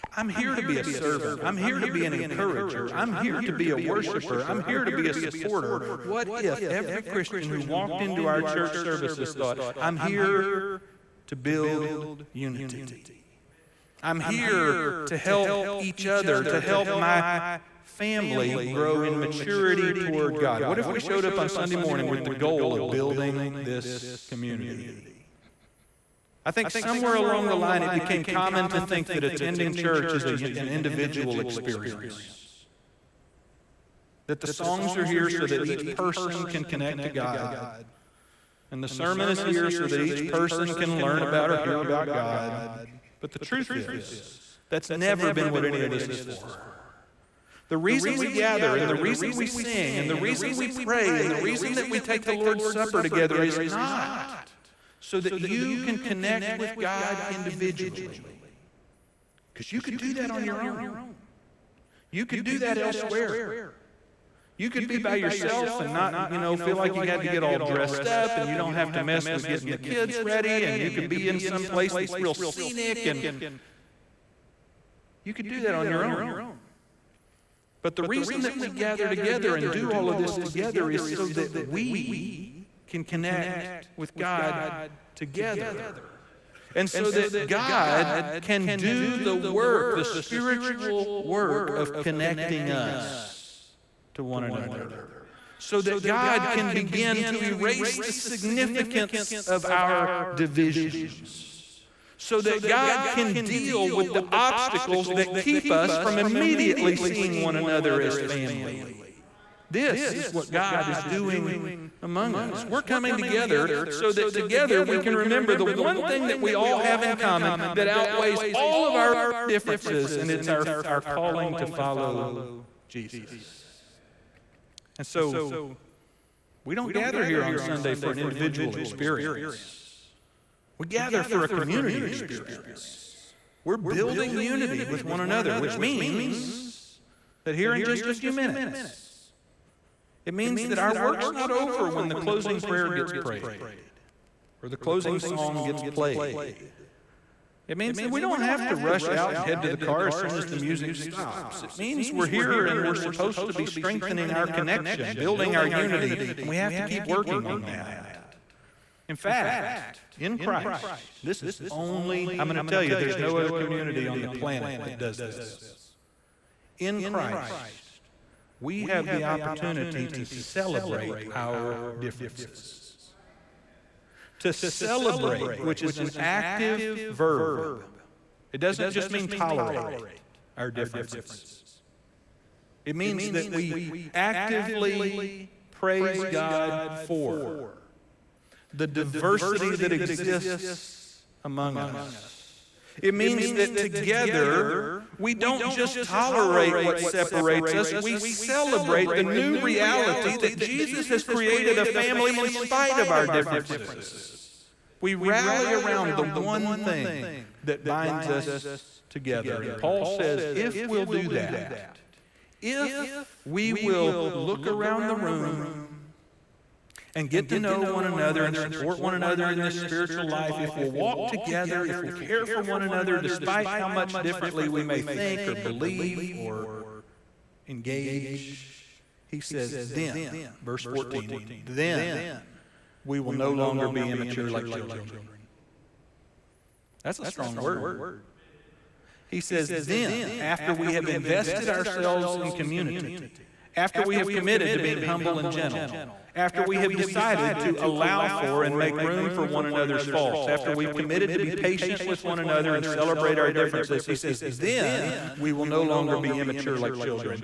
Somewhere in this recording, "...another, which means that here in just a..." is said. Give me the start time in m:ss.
2:15.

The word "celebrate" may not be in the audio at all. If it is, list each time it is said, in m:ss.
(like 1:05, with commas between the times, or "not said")
2:50, 2:54, 3:18, 4:12.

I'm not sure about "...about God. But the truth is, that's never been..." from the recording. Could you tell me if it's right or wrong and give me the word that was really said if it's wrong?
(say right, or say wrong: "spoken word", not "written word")
right.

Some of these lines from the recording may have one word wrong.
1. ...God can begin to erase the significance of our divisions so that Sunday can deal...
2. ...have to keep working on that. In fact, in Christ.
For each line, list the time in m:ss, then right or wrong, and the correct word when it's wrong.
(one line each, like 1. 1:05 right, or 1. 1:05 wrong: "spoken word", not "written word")
1. 1:36 wrong: "God", not "Sunday"
2. 2:36 right.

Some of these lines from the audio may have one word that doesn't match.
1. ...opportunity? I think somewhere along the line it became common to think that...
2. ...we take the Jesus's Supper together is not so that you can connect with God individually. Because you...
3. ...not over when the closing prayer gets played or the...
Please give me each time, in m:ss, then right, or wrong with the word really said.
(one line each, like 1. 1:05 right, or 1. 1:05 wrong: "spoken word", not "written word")
1. 0:24 wrong: "community", not "opportunity"
2. 0:51 wrong: "Lord", not "Jesus"
3. 2:21 wrong: "prayed", not "played".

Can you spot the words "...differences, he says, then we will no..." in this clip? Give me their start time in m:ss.
4:13.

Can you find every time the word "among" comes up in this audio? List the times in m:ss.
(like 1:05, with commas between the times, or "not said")
1:52, 3:11.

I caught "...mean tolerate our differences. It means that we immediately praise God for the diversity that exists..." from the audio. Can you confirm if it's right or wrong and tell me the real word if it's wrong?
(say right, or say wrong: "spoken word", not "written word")
wrong: "actively", not "immediately".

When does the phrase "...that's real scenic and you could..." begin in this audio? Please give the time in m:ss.
1:11.